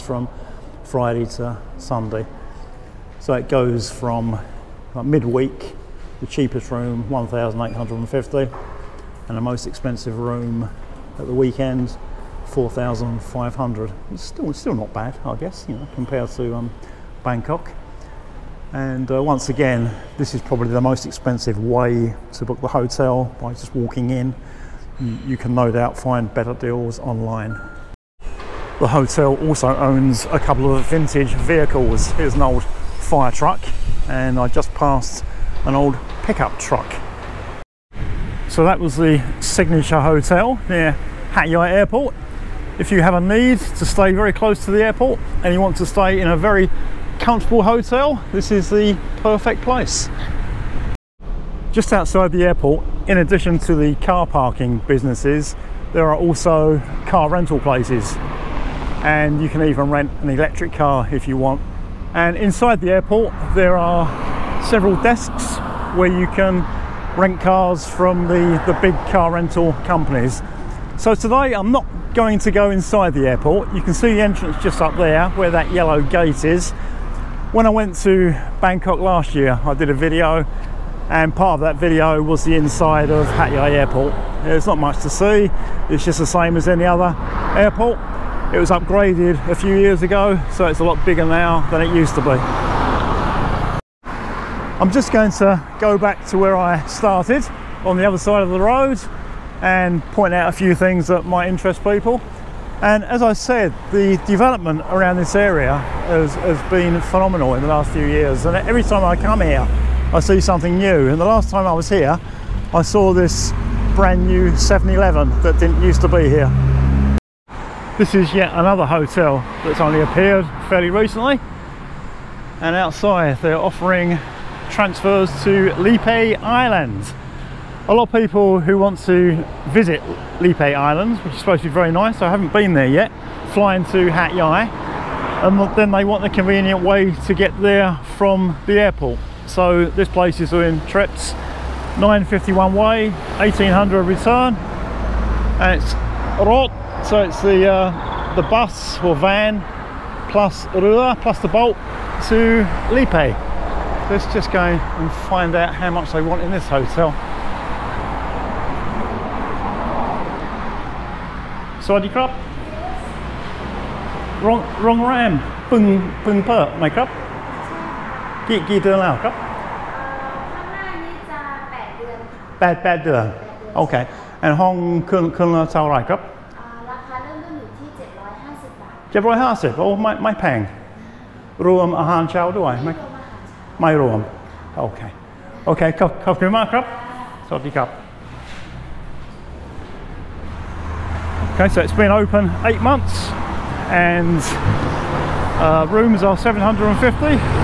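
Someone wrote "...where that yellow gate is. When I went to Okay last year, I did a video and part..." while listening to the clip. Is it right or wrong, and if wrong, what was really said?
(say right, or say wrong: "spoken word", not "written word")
wrong: "Bangkok", not "Okay".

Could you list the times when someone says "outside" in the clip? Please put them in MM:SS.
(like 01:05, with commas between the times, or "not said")
00:51, 02:02.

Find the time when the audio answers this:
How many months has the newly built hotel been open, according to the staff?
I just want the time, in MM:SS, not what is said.
03:12.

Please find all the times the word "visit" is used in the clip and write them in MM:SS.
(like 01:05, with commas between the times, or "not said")
02:09.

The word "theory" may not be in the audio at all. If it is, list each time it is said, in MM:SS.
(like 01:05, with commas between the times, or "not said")
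not said.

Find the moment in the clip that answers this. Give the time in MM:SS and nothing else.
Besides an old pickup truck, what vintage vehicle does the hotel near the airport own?
00:32.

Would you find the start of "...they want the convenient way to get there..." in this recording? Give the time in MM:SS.
02:15.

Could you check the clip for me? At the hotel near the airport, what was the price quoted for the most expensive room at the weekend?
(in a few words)
4,500.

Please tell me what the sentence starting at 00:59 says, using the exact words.
And you can even rent an electric car if you want.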